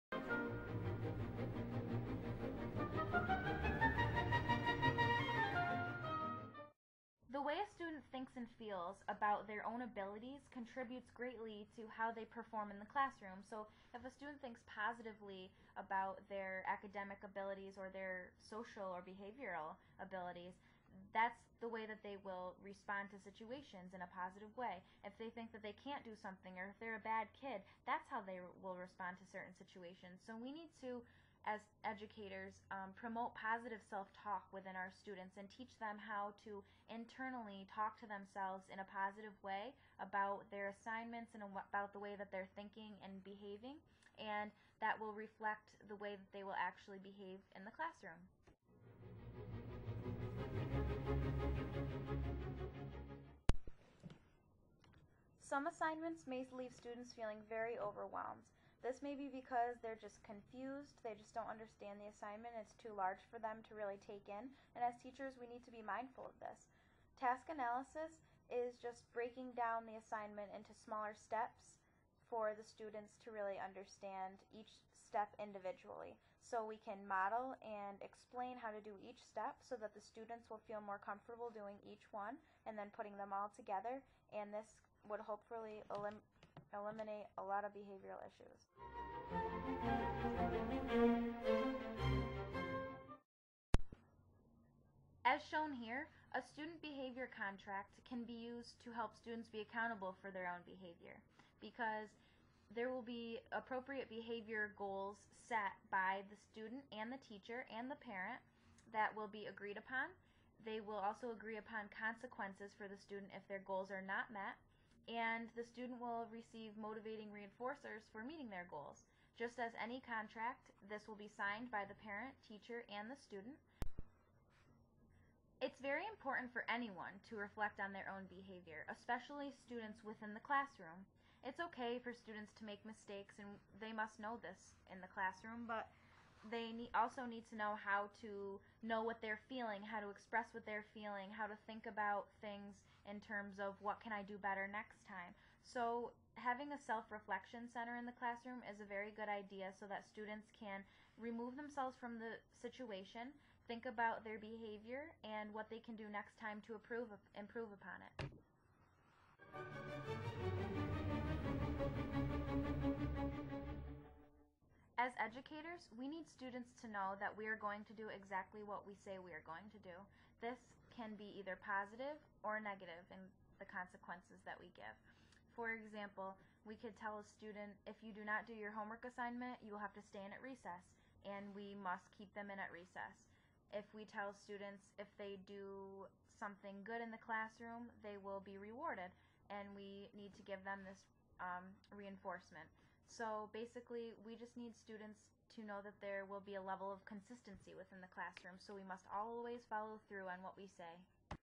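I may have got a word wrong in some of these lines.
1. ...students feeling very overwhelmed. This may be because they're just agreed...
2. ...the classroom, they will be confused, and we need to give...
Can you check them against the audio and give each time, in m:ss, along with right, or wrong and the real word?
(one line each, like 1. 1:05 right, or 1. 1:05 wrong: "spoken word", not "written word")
1. 0:56 wrong: "confused", not "agreed"
2. 3:07 wrong: "rewarded", not "confused".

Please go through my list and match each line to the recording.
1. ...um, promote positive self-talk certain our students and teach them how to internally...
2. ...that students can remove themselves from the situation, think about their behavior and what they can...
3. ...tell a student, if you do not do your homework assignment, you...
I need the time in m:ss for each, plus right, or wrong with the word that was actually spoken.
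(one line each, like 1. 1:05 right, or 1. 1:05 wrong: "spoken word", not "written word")
1. 0:32 wrong: "within", not "certain"
2. 2:29 right
3. 2:57 right.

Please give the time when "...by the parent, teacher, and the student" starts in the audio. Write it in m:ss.
2:01.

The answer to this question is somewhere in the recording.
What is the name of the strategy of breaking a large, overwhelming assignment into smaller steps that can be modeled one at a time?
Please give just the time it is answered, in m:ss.
1:07.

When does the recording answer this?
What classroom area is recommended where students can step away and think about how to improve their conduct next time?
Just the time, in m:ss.
2:26.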